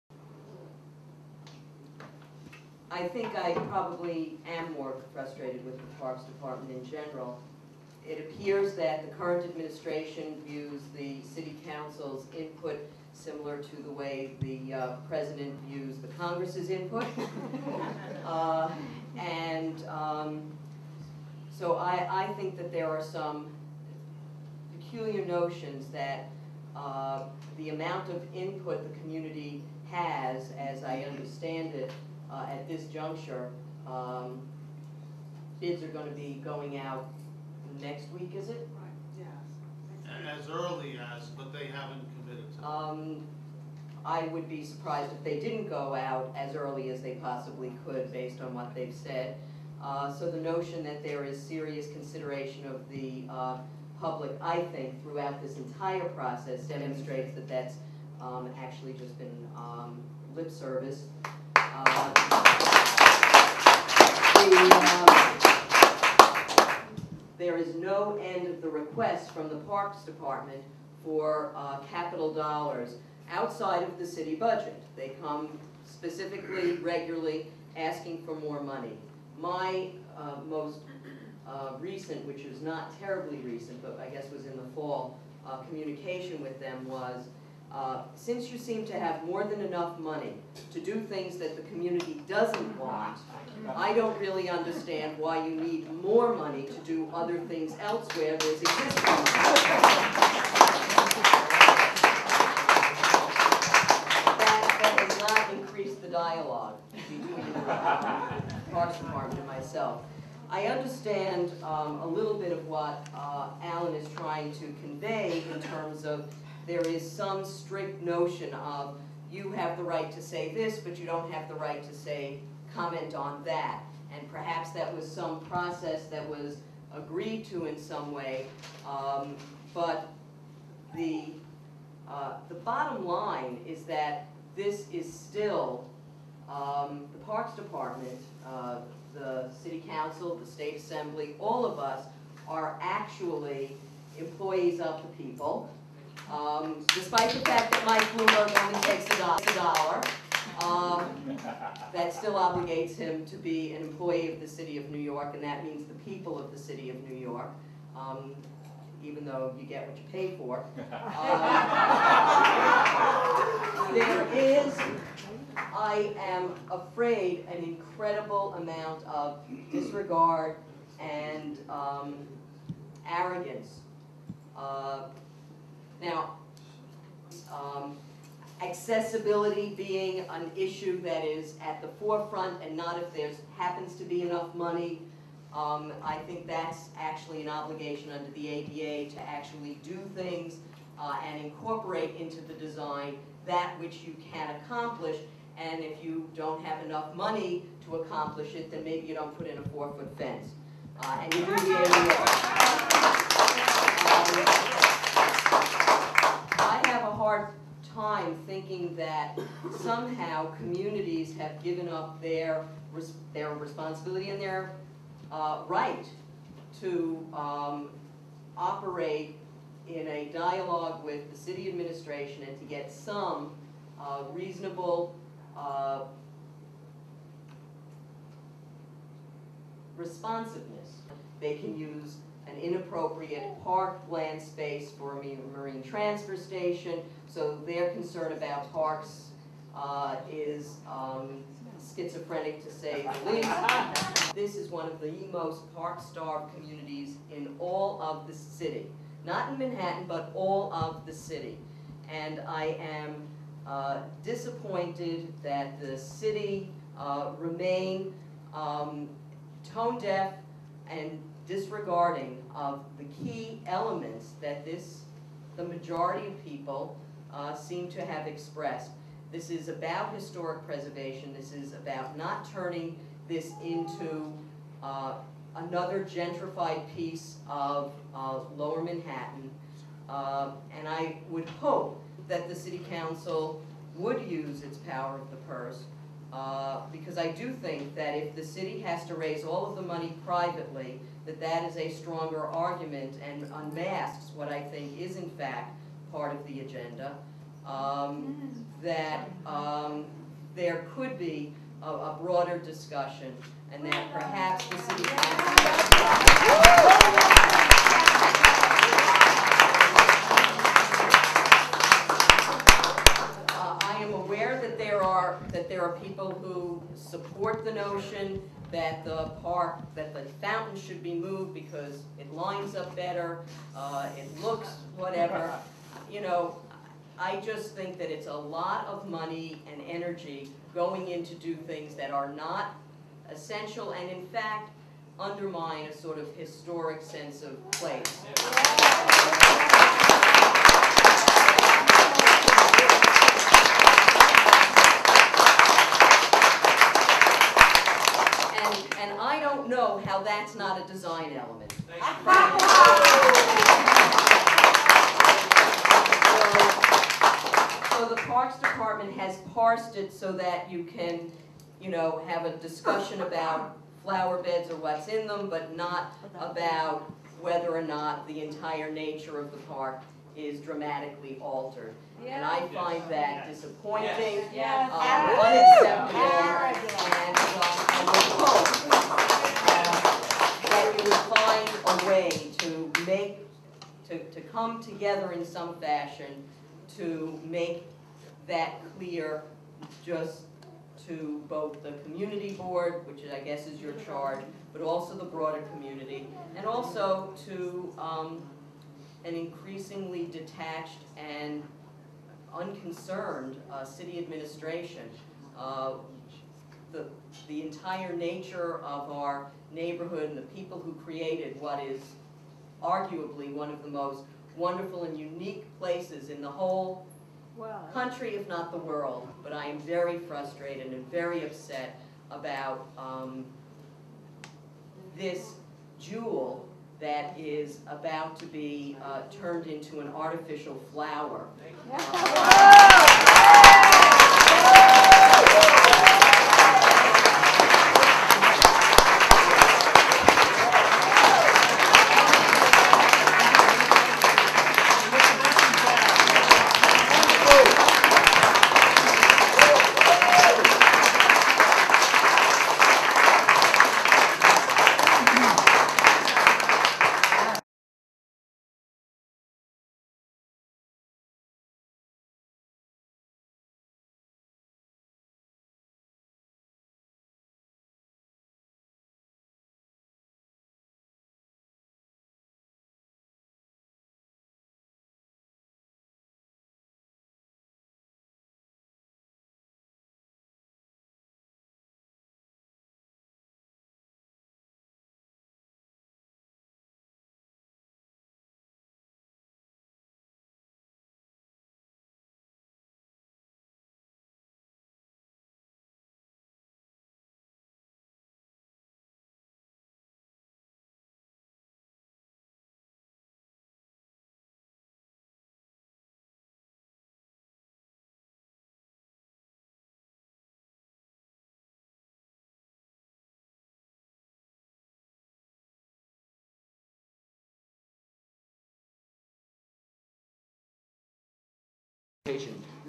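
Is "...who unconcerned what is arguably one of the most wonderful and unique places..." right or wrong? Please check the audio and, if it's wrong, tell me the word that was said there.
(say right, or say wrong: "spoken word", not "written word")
wrong: "created", not "unconcerned".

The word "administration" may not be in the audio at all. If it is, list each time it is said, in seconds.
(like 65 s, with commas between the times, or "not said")
9 s, 221 s, 404 s.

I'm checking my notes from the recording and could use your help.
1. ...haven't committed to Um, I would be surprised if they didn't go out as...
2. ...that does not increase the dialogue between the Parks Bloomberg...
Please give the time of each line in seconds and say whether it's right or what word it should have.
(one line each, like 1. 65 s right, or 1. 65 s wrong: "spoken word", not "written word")
1. 41 s right
2. 104 s wrong: "Department", not "Bloomberg".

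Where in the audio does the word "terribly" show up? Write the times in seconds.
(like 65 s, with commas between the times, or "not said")
82 s.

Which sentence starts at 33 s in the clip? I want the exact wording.
Um, bids are going to be going out next week, is it?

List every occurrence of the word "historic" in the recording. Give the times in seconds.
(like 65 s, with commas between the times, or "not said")
270 s, 336 s.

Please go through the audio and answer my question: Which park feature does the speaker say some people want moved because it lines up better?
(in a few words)
the fountain.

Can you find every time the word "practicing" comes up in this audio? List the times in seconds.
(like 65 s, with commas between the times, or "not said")
not said.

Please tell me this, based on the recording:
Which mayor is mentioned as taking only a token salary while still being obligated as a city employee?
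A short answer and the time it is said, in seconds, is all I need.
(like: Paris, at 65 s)
Mike Bloomberg, at 147 s.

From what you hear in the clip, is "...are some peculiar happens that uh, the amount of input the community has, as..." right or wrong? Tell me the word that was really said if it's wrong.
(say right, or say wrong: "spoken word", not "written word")
wrong: "notions", not "happens".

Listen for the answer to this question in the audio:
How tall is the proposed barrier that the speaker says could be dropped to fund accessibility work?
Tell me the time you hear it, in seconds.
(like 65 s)
199 s.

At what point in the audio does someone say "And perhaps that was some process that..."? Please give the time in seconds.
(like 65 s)
124 s.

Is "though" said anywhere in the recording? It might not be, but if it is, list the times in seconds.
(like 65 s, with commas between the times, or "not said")
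159 s.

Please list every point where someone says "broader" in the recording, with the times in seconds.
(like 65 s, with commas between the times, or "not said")
302 s, 395 s.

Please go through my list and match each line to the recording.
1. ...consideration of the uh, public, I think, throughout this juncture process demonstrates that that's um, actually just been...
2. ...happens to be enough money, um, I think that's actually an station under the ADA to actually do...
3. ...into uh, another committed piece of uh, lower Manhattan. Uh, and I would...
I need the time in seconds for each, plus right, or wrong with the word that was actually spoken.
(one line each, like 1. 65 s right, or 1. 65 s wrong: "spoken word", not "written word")
1. 51 s wrong: "entire", not "juncture"
2. 183 s wrong: "obligation", not "station"
3. 273 s wrong: "gentrified", not "committed".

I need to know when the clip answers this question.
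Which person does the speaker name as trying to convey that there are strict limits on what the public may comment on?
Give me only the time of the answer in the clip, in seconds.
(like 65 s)
113 s.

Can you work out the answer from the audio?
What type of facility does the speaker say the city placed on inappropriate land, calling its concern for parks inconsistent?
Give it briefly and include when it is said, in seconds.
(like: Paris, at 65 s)
marine transfer station, at 235 s.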